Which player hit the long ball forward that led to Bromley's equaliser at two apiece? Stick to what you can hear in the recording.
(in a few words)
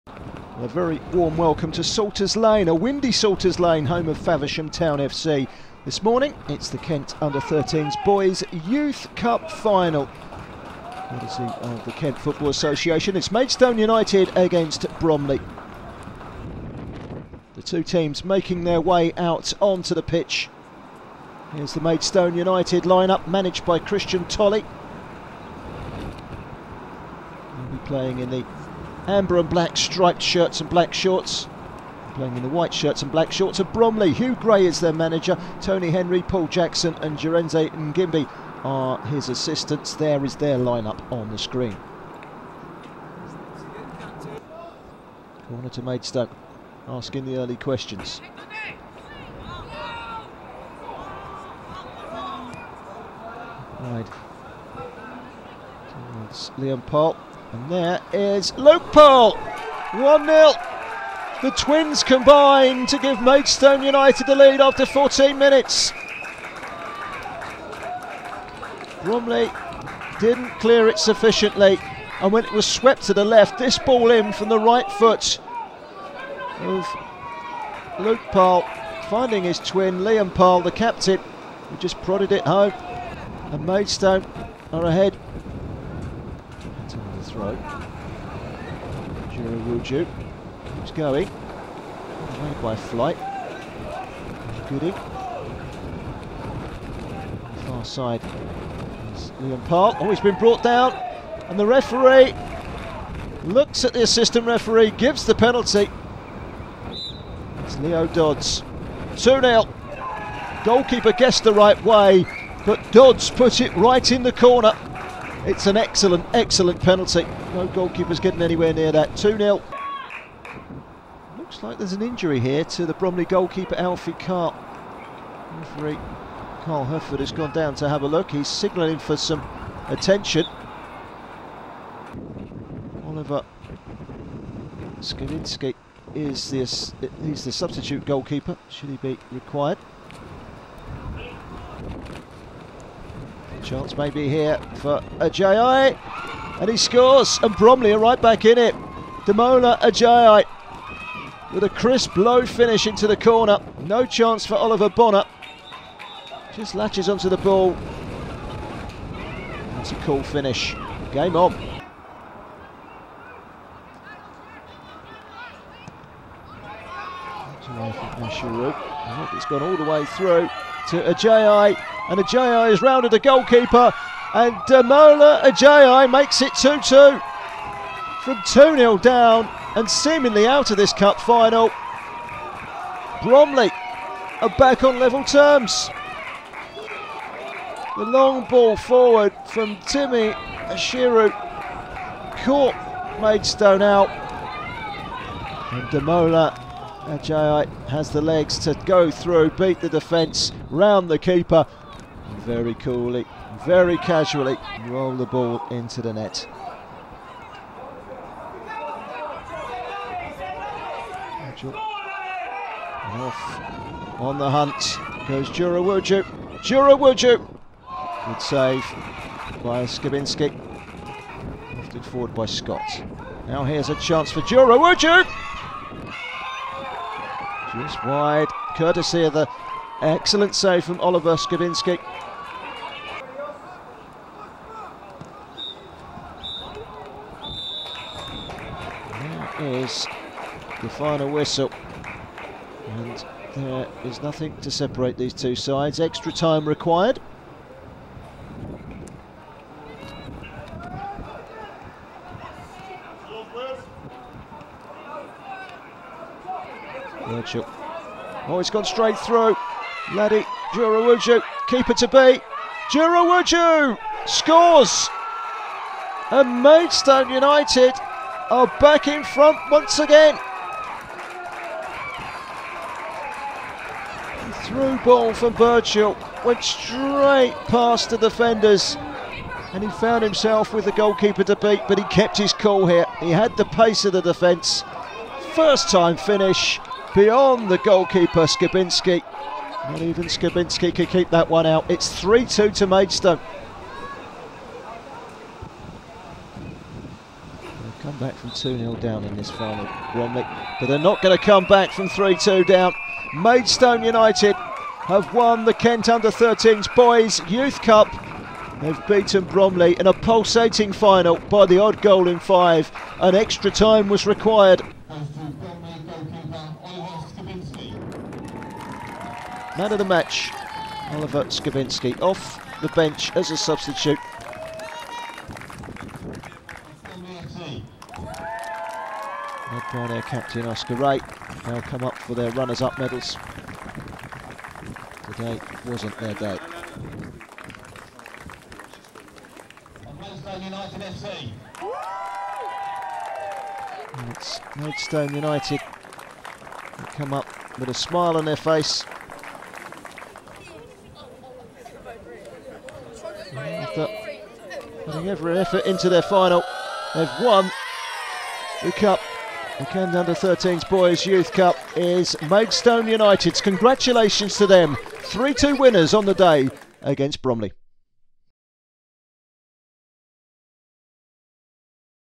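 Timmy Ashiru.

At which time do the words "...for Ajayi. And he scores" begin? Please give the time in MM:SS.
02:24.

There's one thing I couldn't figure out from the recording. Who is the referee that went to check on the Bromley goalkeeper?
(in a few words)
Carl Hufford.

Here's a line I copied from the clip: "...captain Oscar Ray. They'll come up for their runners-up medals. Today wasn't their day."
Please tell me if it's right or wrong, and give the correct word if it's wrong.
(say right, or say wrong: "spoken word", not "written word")
right.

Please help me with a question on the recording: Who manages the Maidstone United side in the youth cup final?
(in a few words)
Christian Tolley.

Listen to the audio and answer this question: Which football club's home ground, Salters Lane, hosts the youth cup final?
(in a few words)
Faversham Town FC.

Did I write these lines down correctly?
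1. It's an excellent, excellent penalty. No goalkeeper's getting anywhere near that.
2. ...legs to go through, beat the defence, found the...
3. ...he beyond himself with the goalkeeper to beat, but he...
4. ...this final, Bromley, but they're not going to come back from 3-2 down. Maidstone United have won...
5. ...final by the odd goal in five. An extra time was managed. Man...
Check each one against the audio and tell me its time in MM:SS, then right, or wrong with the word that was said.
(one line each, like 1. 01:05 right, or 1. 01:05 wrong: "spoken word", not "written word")
1. 01:55 right
2. 03:18 wrong: "round", not "found"
3. 04:39 wrong: "found", not "beyond"
4. 04:59 right
5. 05:10 wrong: "required", not "managed".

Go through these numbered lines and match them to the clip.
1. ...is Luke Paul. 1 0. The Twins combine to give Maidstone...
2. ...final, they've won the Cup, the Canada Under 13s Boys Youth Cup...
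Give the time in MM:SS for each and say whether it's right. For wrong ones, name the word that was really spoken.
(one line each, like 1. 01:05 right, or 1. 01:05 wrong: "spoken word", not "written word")
1. 00:58 right
2. 05:56 right.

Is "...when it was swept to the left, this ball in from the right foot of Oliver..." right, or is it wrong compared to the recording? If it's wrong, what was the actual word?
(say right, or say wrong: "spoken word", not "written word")
wrong: "Luke", not "Oliver".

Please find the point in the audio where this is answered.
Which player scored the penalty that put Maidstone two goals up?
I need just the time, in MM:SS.
01:47.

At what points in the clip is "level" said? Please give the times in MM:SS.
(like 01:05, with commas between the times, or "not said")
03:04.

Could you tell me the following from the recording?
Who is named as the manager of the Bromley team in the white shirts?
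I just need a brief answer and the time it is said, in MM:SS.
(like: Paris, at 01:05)
Hugh Gray, at 00:34.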